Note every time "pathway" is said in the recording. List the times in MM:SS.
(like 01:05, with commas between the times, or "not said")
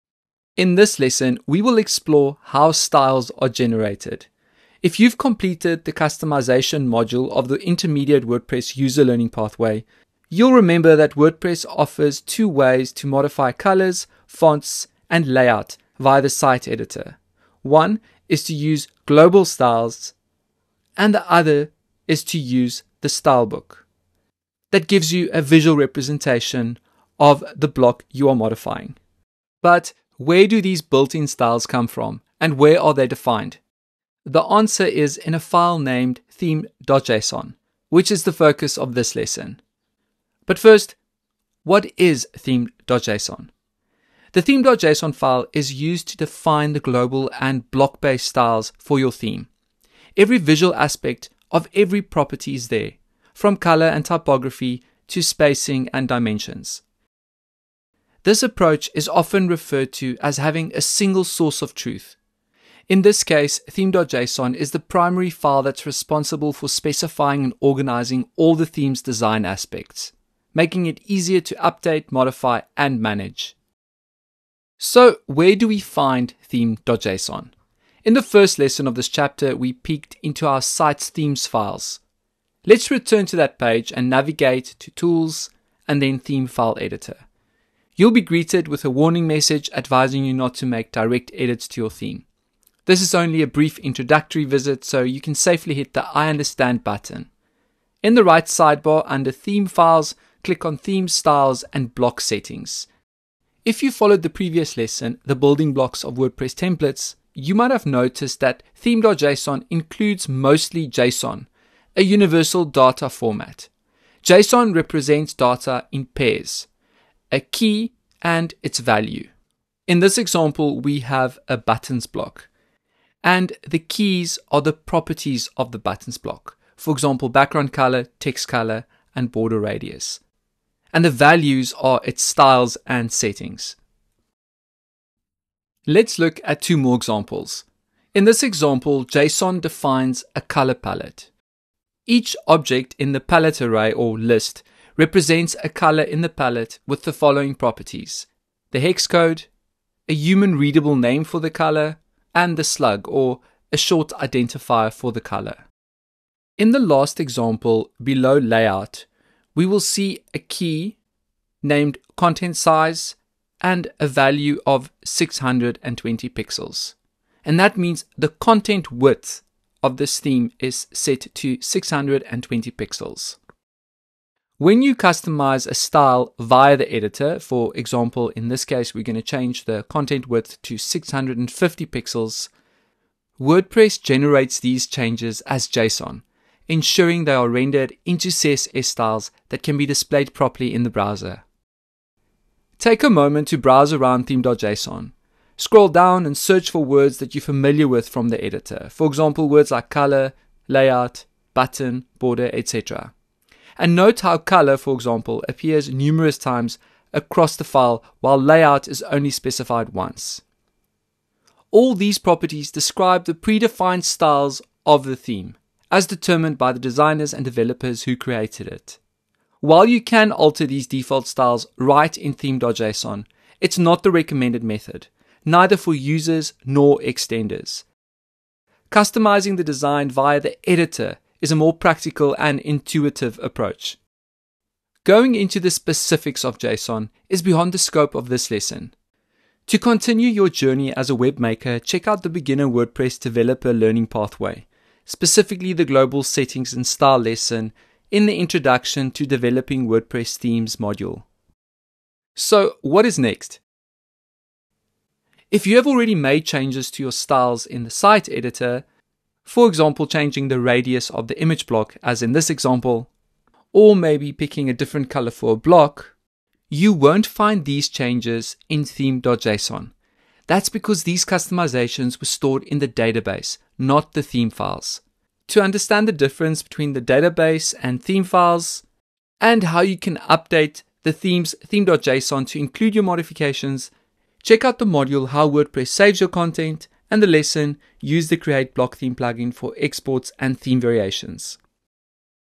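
00:09, 04:04.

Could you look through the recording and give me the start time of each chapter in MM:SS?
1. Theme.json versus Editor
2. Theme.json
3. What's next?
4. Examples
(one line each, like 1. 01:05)
1. 03:39
2. 00:29
3. 04:11
4. 01:58.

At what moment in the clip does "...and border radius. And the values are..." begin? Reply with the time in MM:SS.
02:09.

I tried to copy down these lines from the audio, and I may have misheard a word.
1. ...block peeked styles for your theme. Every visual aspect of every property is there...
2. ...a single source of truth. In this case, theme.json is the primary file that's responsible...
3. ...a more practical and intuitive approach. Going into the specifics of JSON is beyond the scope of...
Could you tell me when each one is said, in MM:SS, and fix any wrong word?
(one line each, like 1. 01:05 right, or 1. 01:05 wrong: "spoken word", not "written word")
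1. 00:47 wrong: "based", not "peeked"
2. 01:00 right
3. 03:51 right.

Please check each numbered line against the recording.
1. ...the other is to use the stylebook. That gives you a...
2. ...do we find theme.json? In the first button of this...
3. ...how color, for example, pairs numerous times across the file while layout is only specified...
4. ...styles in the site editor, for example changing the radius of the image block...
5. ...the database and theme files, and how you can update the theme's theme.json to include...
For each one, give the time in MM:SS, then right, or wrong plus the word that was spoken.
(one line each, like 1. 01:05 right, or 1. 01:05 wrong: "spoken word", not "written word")
1. 00:21 right
2. 01:15 wrong: "lesson", not "button"
3. 03:24 wrong: "appears", not "pairs"
4. 04:17 right
5. 04:36 right.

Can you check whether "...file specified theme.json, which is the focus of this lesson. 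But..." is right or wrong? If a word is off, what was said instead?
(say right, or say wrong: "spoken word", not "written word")
wrong: "named", not "specified".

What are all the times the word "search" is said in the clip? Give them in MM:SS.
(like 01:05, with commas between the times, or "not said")
03:16.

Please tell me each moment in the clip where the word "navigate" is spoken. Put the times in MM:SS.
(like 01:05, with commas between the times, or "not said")
01:24.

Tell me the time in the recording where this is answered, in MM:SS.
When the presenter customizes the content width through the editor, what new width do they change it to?
03:00.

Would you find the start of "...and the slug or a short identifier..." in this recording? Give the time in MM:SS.
02:32.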